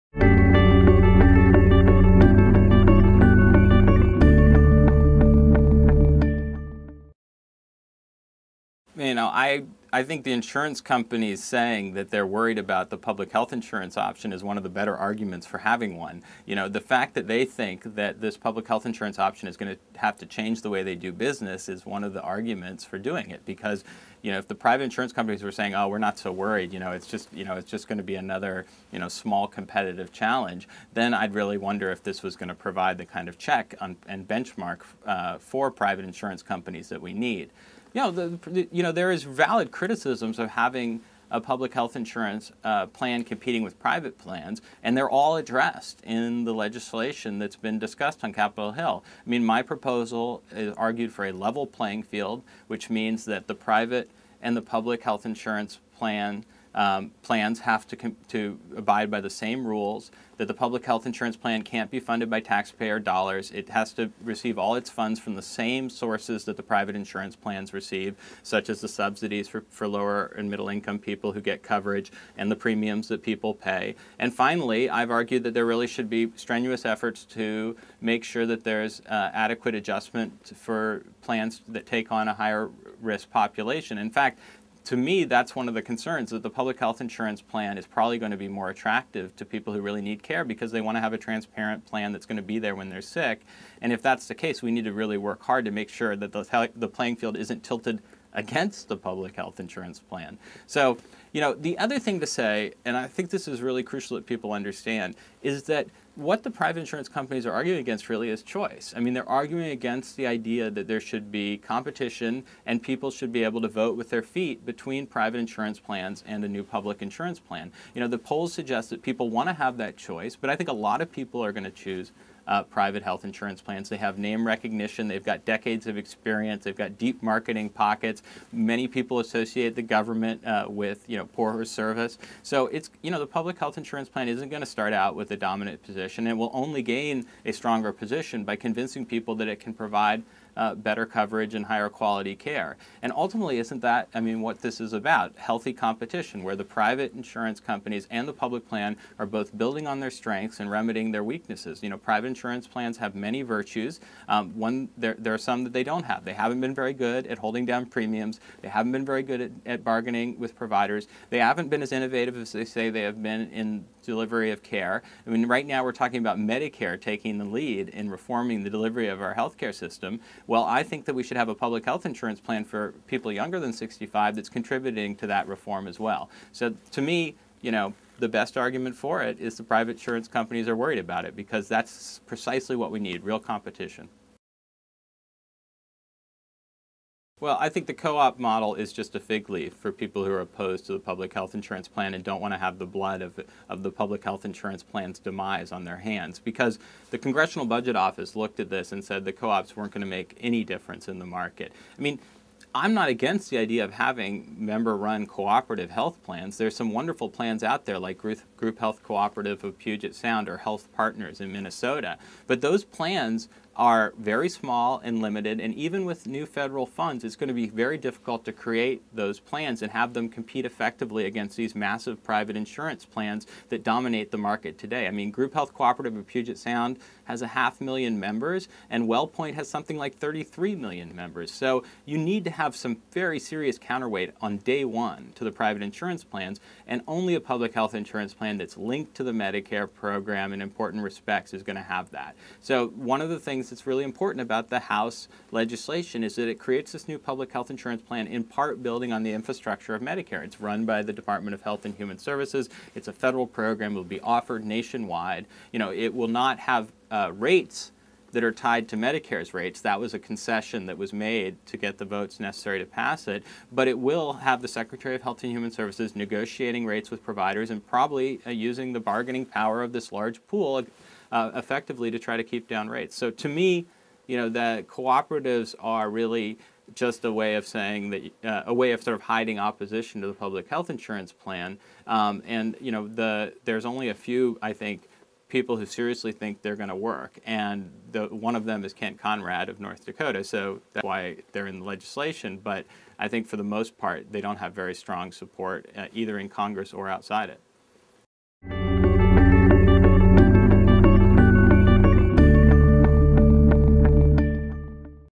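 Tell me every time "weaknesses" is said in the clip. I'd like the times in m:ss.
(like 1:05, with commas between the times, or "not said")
2:31.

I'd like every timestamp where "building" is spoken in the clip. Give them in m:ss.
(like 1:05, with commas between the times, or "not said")
2:29, 4:08.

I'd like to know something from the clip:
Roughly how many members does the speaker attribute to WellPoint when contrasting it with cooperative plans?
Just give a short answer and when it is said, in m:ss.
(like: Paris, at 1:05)
33 million, at 3:50.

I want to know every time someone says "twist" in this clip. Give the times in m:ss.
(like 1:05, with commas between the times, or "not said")
not said.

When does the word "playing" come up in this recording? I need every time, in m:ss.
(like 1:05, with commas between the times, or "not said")
0:51, 1:36.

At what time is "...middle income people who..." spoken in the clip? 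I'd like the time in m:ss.
1:10.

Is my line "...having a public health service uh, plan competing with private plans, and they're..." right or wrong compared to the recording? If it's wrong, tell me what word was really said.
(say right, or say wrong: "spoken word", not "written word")
wrong: "insurance", not "service".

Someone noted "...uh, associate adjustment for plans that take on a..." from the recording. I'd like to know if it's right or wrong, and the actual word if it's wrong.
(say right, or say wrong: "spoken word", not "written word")
wrong: "adequate", not "associate".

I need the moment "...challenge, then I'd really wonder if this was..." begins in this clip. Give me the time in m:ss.
0:30.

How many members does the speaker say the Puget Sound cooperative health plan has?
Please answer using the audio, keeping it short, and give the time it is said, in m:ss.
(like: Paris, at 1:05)
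half million, at 3:47.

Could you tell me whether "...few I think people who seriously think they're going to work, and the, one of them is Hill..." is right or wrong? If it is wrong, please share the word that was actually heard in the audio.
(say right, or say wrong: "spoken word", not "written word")
wrong: "Kent", not "Hill".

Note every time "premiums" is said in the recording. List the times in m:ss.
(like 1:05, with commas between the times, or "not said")
1:12, 2:37.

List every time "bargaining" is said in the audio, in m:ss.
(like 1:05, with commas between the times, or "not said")
2:39, 4:29.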